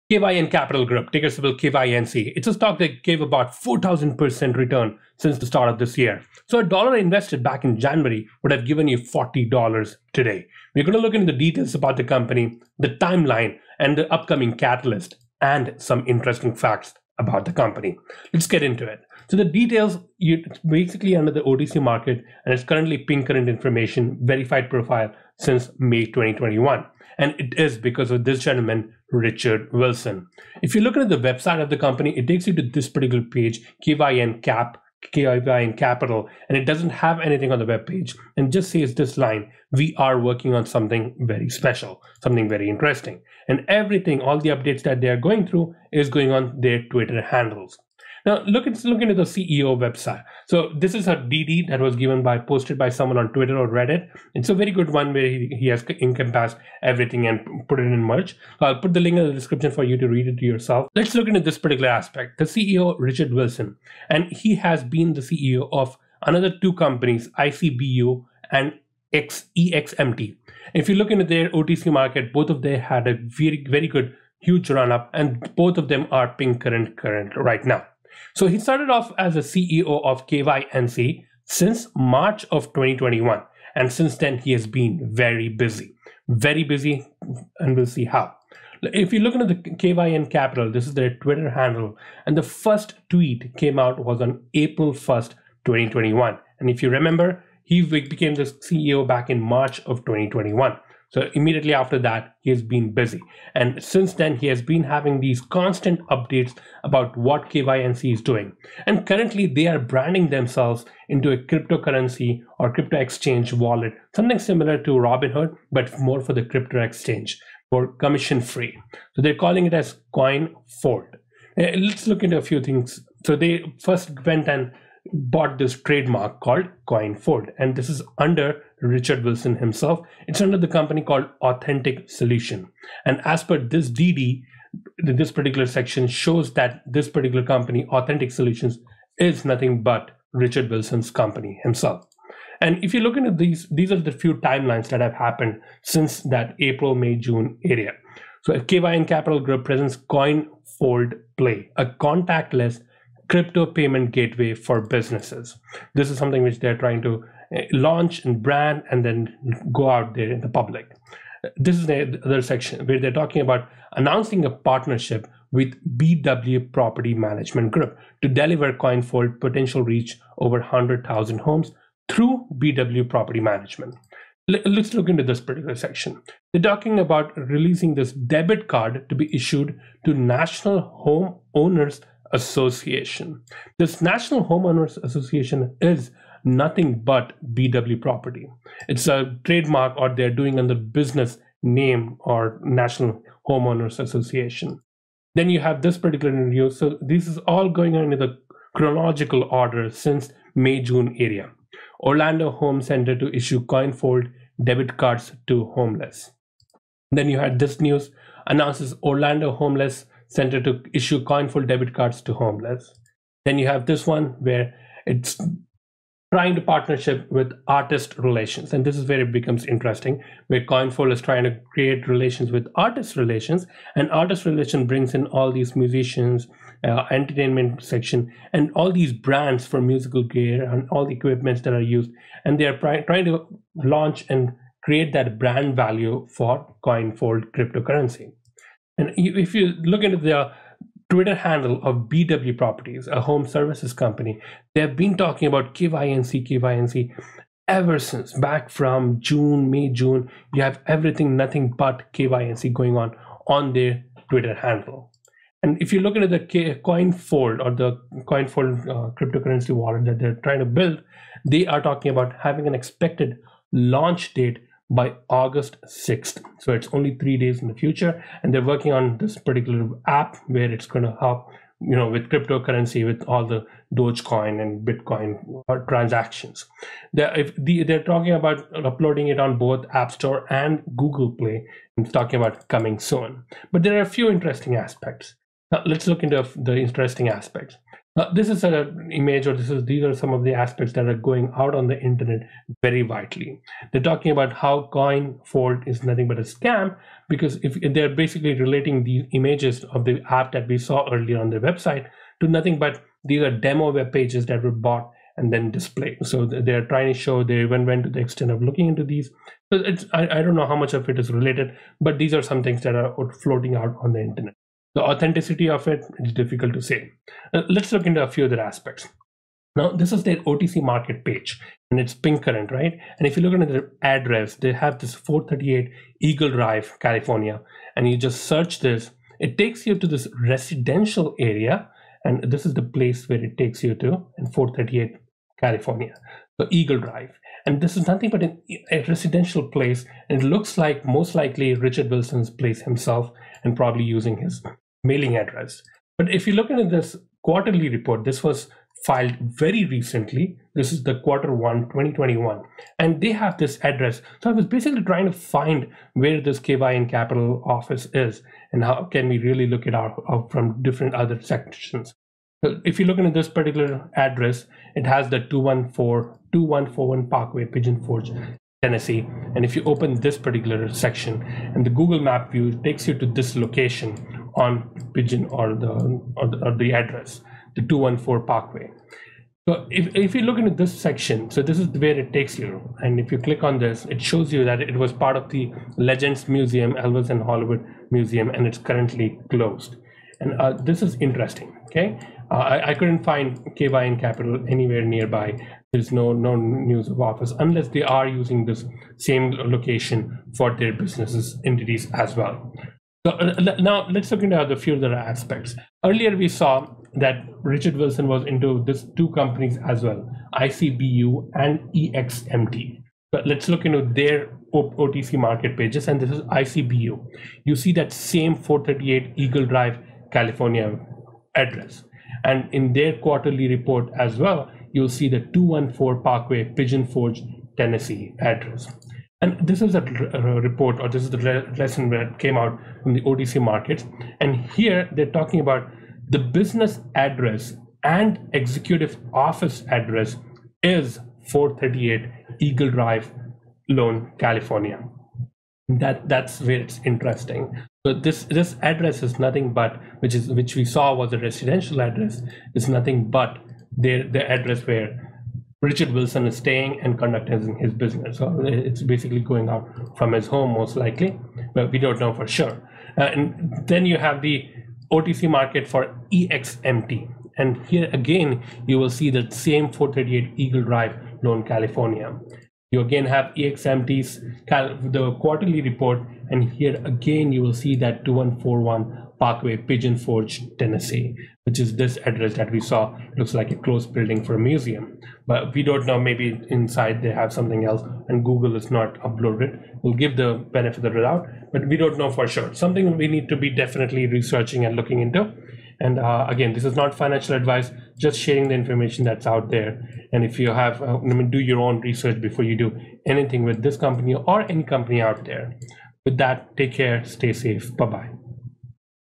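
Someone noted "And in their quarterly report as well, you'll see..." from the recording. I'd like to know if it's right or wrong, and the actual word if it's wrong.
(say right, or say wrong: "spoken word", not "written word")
right.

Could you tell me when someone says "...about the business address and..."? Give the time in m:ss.
7:15.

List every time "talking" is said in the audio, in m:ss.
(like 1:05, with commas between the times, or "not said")
2:43, 2:56, 4:05, 4:21, 4:38, 4:42, 4:54, 7:15.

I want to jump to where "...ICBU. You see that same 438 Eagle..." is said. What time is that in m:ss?
6:56.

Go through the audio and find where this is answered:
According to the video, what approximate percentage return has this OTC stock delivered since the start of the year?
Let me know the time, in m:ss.
0:03.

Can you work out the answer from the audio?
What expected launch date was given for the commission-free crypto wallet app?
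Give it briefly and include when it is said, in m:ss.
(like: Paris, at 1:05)
August 6th, at 4:25.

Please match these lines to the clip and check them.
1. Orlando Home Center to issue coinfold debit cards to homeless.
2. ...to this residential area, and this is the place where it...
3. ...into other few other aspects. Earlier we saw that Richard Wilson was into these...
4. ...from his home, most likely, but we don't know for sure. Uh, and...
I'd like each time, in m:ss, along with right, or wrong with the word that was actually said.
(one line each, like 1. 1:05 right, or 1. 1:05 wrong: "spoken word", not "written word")
1. 3:21 right
2. 5:29 right
3. 6:44 right
4. 7:40 right.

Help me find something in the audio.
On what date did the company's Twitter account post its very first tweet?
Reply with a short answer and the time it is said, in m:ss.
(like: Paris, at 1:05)
April 1st, 2021, at 1:34.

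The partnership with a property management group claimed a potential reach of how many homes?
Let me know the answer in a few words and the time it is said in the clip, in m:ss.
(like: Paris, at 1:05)
100,000, at 2:50.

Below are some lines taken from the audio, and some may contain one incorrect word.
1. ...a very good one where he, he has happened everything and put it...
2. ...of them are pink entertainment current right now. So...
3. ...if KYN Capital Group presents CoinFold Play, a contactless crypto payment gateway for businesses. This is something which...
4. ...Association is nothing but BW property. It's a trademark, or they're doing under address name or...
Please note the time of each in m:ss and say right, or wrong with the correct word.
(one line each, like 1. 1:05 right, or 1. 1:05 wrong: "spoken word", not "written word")
1. 0:54 wrong: "encompassed", not "happened"
2. 1:15 wrong: "current", not "entertainment"
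3. 2:28 right
4. 3:05 wrong: "business", not "address".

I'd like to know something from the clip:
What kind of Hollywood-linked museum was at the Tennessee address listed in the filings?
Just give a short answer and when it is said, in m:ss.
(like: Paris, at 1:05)
Elvis, at 6:26.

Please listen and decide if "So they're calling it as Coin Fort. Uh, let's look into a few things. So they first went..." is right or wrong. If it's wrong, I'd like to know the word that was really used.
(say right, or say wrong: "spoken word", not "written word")
right.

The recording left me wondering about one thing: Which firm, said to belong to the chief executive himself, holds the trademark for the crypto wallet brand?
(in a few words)
Authentic Solution.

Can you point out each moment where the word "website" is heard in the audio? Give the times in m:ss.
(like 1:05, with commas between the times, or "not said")
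0:31, 0:49, 5:01.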